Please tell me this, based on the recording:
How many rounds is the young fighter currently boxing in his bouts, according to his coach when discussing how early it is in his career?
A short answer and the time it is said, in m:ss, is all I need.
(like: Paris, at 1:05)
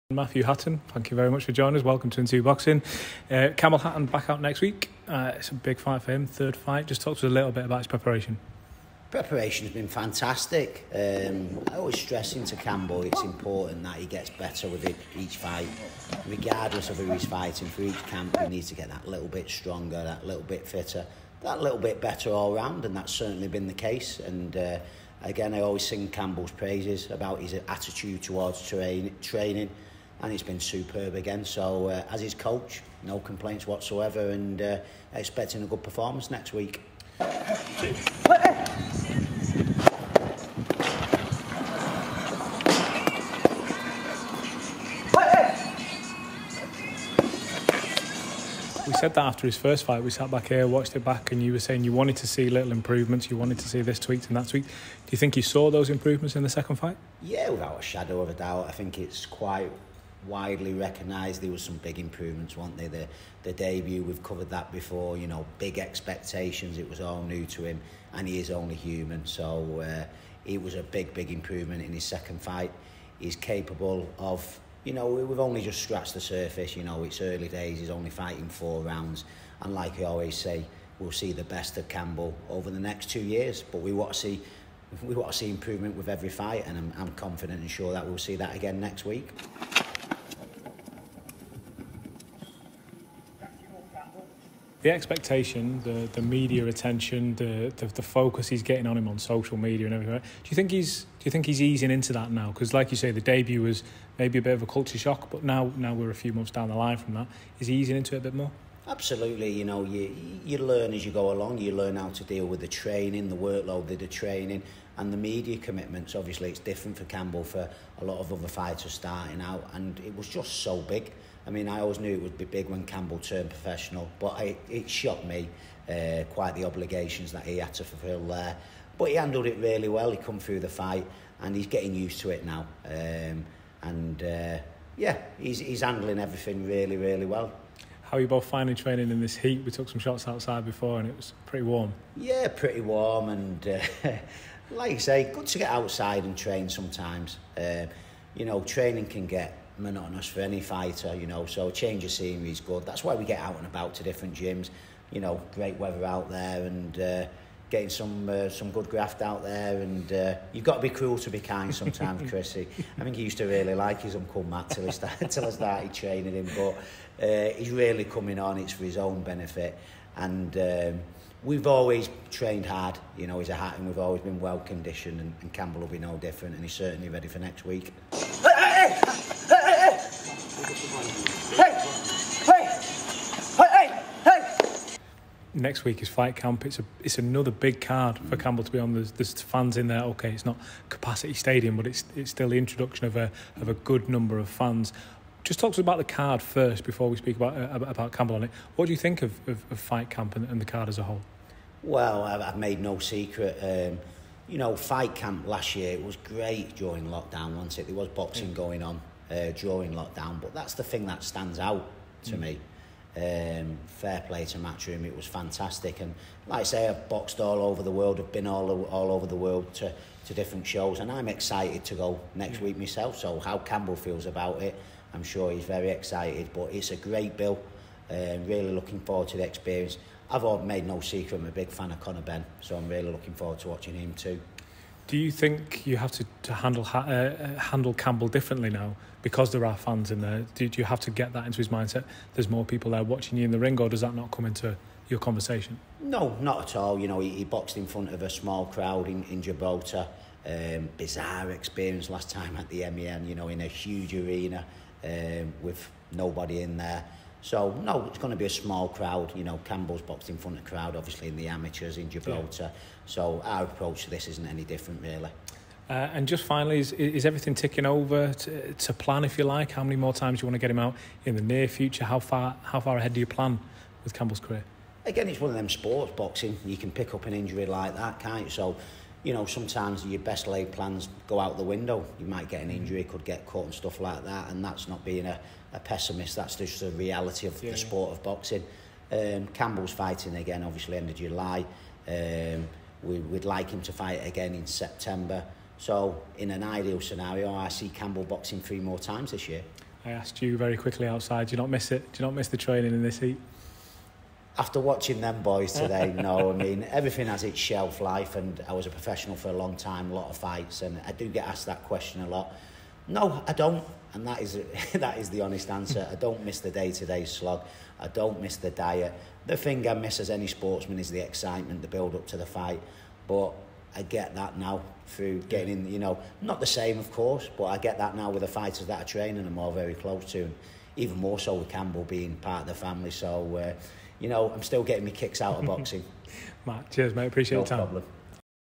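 4, at 1:18.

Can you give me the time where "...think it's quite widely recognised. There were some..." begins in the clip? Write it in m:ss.
0:58.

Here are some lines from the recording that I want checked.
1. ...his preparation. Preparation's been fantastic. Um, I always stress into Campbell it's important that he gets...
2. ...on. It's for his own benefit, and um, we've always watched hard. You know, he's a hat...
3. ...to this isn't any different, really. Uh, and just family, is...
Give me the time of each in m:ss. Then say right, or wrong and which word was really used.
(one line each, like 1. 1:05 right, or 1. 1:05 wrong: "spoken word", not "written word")
1. 0:07 right
2. 2:48 wrong: "trained", not "watched"
3. 4:24 wrong: "finally", not "family".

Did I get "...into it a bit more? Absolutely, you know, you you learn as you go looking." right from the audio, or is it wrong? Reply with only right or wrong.
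wrong.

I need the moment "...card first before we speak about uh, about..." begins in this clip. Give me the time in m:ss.
3:16.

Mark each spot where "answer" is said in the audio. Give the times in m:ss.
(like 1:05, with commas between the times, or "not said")
5:15.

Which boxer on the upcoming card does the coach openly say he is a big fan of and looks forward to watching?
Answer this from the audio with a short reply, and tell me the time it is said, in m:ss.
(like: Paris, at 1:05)
Conor Benn, at 3:51.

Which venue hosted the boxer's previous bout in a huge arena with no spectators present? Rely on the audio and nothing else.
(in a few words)
MEN.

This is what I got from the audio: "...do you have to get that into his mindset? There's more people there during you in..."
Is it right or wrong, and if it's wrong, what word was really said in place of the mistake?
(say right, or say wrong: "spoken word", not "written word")
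wrong: "watching", not "during".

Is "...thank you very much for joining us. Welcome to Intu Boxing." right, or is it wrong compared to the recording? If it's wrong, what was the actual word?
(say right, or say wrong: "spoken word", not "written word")
right.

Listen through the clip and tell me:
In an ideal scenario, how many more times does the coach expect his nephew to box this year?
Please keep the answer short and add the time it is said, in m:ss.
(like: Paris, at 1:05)
3, at 4:58.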